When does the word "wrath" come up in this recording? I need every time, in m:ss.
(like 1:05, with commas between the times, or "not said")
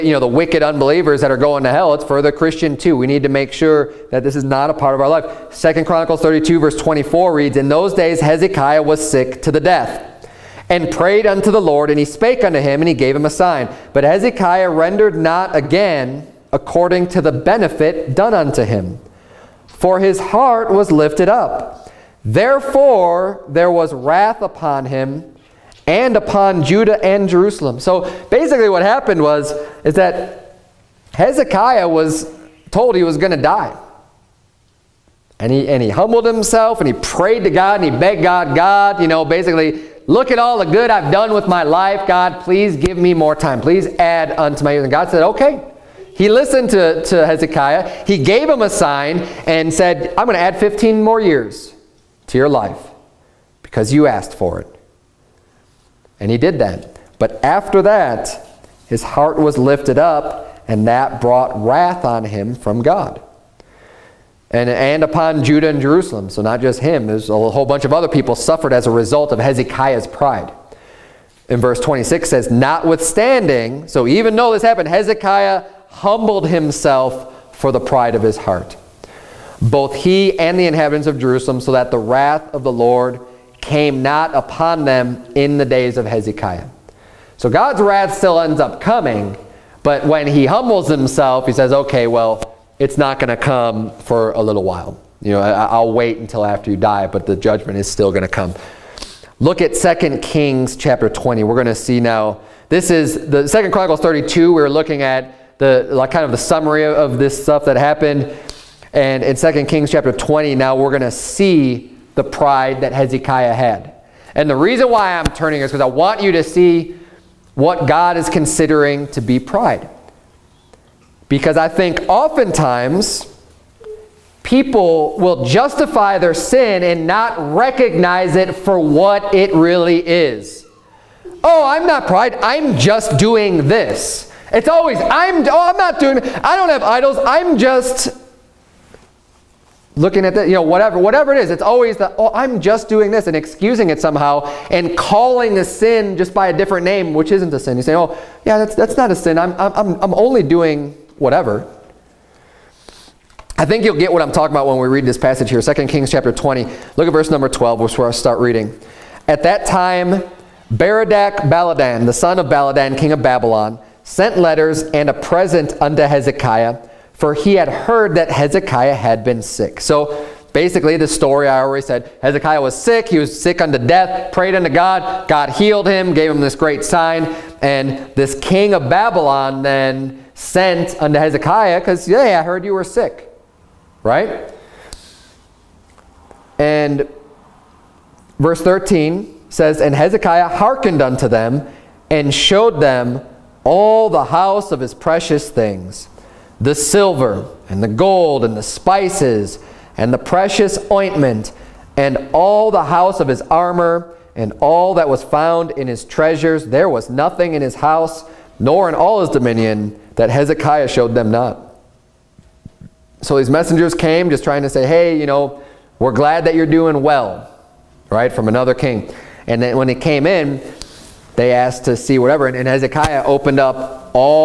0:23, 1:01, 1:21, 1:27.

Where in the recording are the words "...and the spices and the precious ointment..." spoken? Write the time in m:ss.
3:18.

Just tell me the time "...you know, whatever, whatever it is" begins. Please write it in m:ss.
2:20.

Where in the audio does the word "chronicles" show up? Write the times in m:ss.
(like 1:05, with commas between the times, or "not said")
0:05, 1:43.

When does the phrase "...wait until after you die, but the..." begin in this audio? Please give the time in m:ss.
1:35.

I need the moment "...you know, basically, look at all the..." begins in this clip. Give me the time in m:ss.
0:39.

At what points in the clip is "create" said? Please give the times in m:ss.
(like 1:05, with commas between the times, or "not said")
not said.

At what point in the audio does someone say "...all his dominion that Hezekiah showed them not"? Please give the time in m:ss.
3:28.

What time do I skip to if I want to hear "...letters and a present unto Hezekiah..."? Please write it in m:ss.
2:44.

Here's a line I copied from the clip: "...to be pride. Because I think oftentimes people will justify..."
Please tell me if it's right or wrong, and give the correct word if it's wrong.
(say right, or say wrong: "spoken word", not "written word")
right.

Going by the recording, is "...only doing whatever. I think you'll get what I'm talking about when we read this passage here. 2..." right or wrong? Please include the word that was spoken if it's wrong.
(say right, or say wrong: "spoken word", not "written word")
right.